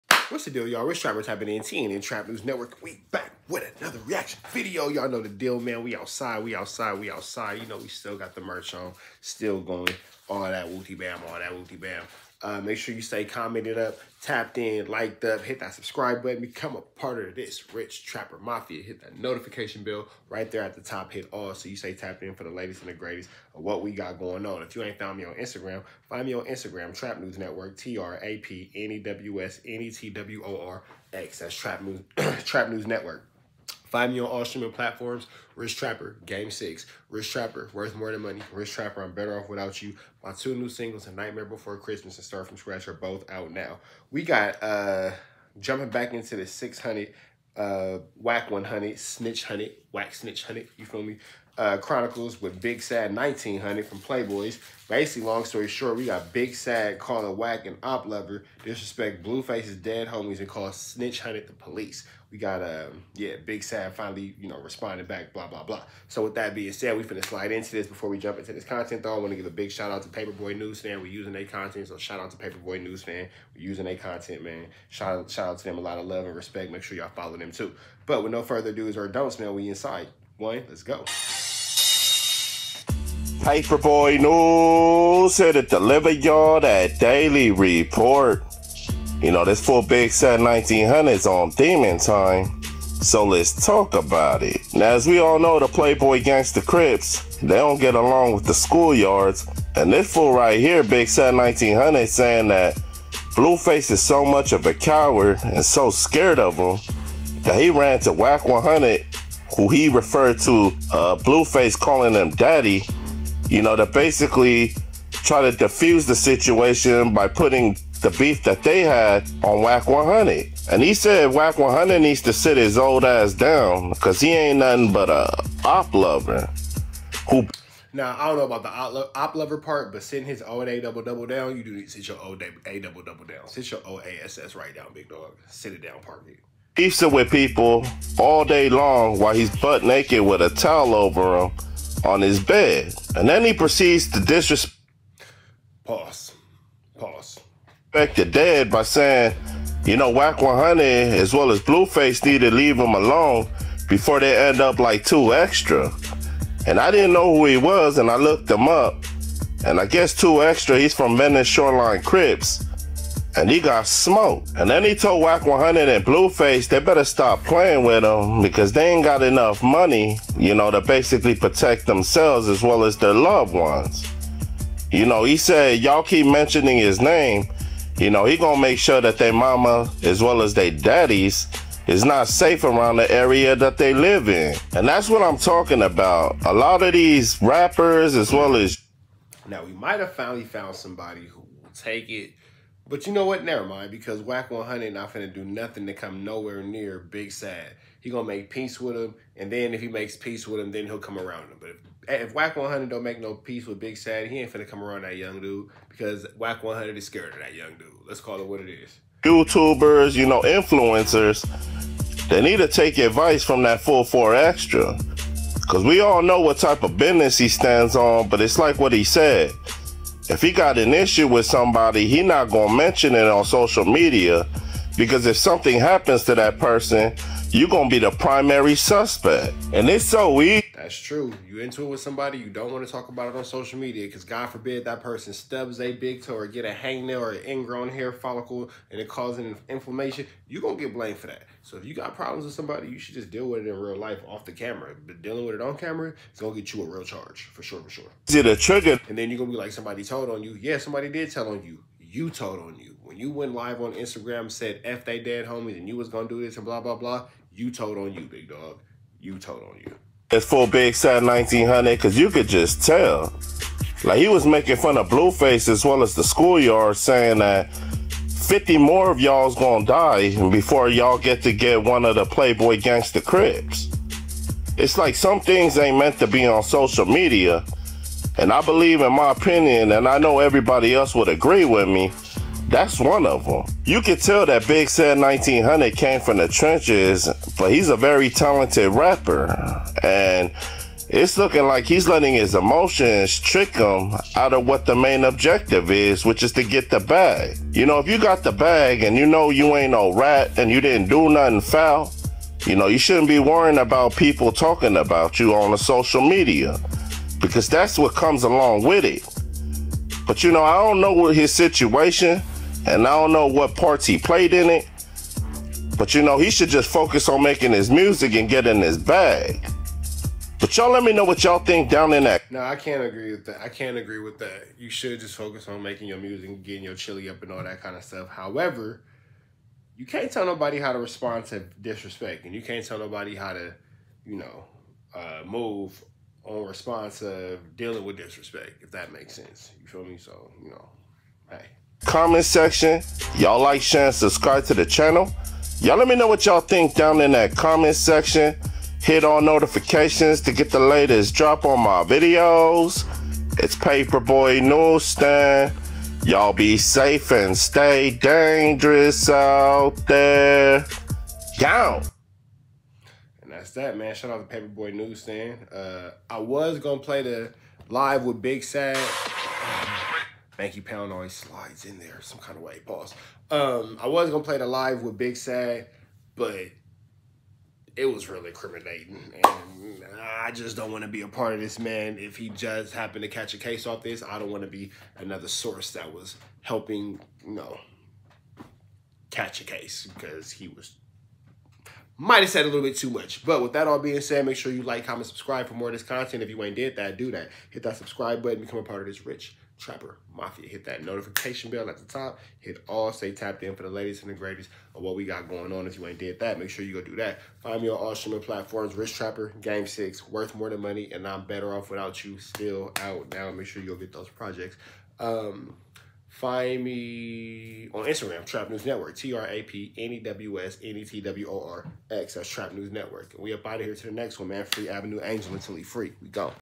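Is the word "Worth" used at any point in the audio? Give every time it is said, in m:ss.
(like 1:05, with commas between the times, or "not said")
0:37, 6:50.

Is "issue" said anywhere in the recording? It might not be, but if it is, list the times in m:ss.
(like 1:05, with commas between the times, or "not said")
3:40.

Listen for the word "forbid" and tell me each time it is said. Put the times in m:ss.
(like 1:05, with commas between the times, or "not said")
3:54.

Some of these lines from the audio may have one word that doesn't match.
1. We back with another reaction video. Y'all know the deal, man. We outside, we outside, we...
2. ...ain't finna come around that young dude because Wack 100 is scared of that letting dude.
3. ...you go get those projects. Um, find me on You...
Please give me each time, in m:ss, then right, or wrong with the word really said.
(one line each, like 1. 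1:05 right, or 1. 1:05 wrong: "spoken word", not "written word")
1. 0:02 right
2. 3:24 wrong: "young", not "letting"
3. 6:53 wrong: "Instagram", not "You".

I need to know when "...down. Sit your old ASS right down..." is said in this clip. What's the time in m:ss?
2:13.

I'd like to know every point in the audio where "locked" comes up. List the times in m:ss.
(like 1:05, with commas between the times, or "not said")
not said.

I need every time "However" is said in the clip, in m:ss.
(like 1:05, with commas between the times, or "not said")
5:28.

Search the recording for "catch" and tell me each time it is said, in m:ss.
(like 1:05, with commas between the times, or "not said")
6:23, 6:29.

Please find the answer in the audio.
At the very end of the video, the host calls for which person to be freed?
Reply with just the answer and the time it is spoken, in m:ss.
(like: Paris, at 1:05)
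Avenue Angel, at 7:04.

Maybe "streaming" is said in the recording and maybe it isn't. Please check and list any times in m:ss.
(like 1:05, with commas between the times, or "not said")
0:34, 6:48.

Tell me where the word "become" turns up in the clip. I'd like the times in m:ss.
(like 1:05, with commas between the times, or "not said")
0:16, 6:38.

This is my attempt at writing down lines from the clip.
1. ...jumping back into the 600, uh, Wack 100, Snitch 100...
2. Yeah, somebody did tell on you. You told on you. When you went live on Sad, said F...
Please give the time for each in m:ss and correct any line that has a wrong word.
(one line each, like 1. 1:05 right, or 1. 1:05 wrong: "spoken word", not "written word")
1. 0:45 right
2. 4:10 wrong: "Instagram", not "Sad".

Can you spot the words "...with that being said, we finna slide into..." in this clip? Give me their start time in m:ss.
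1:06.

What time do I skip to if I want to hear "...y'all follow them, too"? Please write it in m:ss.
1:16.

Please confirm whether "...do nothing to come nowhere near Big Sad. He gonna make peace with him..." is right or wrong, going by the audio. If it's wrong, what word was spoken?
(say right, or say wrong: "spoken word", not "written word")
right.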